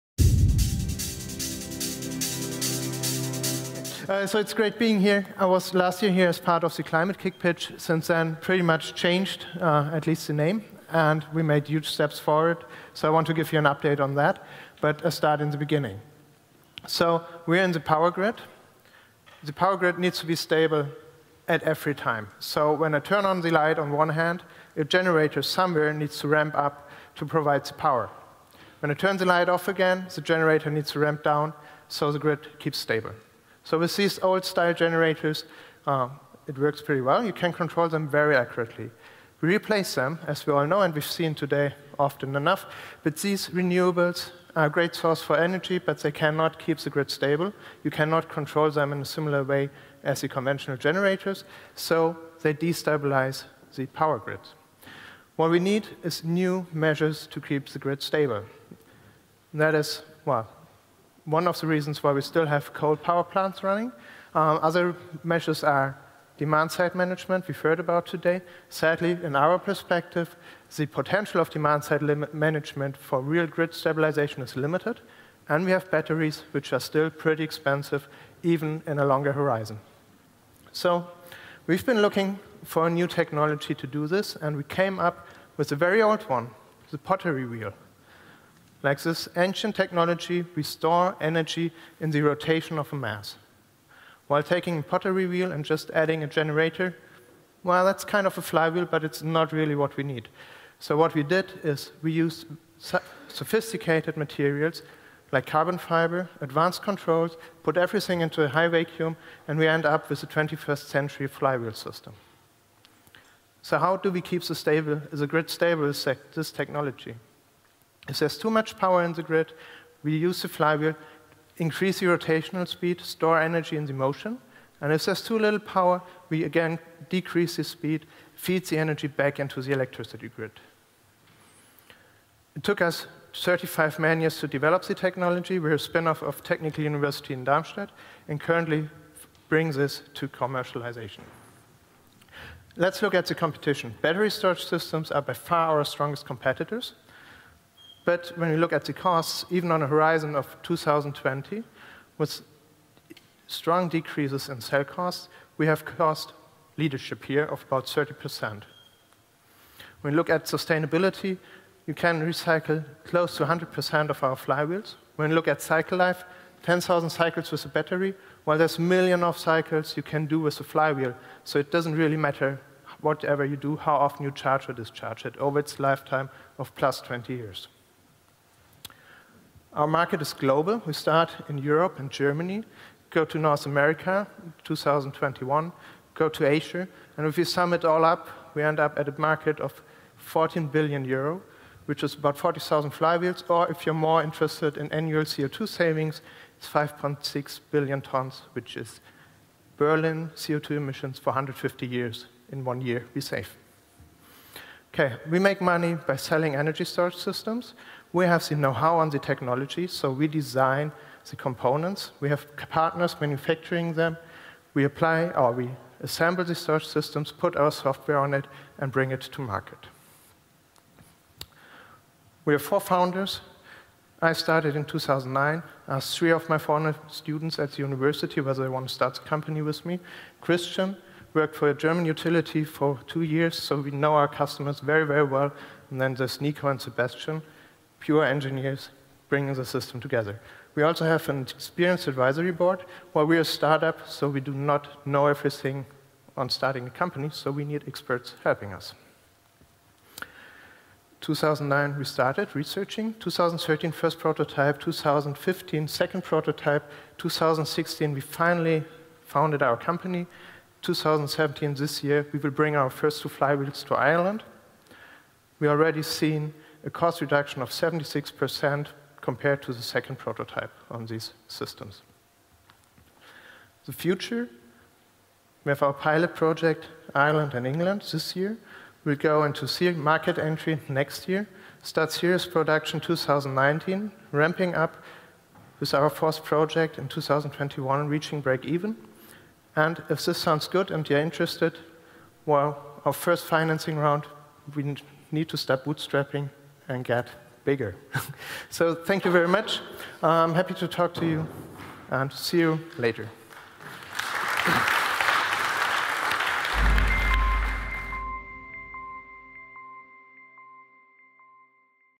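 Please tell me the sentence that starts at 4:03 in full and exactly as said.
While we're a startup, so we do not know everything on starting a company, so we need experts helping us.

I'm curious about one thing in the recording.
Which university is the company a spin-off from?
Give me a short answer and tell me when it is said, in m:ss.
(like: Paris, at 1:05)
Technical University in Darmstadt, at 2:16.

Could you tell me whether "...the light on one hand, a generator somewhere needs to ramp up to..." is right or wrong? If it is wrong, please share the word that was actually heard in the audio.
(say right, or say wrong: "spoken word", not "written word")
right.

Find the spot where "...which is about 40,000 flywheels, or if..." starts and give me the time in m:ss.
3:11.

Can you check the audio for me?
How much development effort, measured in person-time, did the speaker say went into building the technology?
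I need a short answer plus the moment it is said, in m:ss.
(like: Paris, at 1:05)
35 man years, at 2:13.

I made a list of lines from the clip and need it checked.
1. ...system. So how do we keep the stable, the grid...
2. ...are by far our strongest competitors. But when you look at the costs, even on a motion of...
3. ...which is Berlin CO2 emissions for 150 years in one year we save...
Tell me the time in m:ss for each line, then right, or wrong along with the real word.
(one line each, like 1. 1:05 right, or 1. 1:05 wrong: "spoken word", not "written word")
1. 1:51 right
2. 2:25 wrong: "horizon", not "motion"
3. 3:18 right.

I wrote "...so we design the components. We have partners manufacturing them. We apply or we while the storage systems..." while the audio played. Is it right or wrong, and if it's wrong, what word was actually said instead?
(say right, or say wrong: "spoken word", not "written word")
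wrong: "assemble", not "while".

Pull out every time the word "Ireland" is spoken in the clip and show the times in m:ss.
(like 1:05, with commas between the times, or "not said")
4:23, 4:37.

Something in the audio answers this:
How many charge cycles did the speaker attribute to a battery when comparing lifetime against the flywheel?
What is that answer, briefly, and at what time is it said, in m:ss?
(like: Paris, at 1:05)
10,000, at 2:46.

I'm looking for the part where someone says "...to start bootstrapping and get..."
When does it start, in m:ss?
4:55.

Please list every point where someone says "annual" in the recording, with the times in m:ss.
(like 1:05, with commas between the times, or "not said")
3:14.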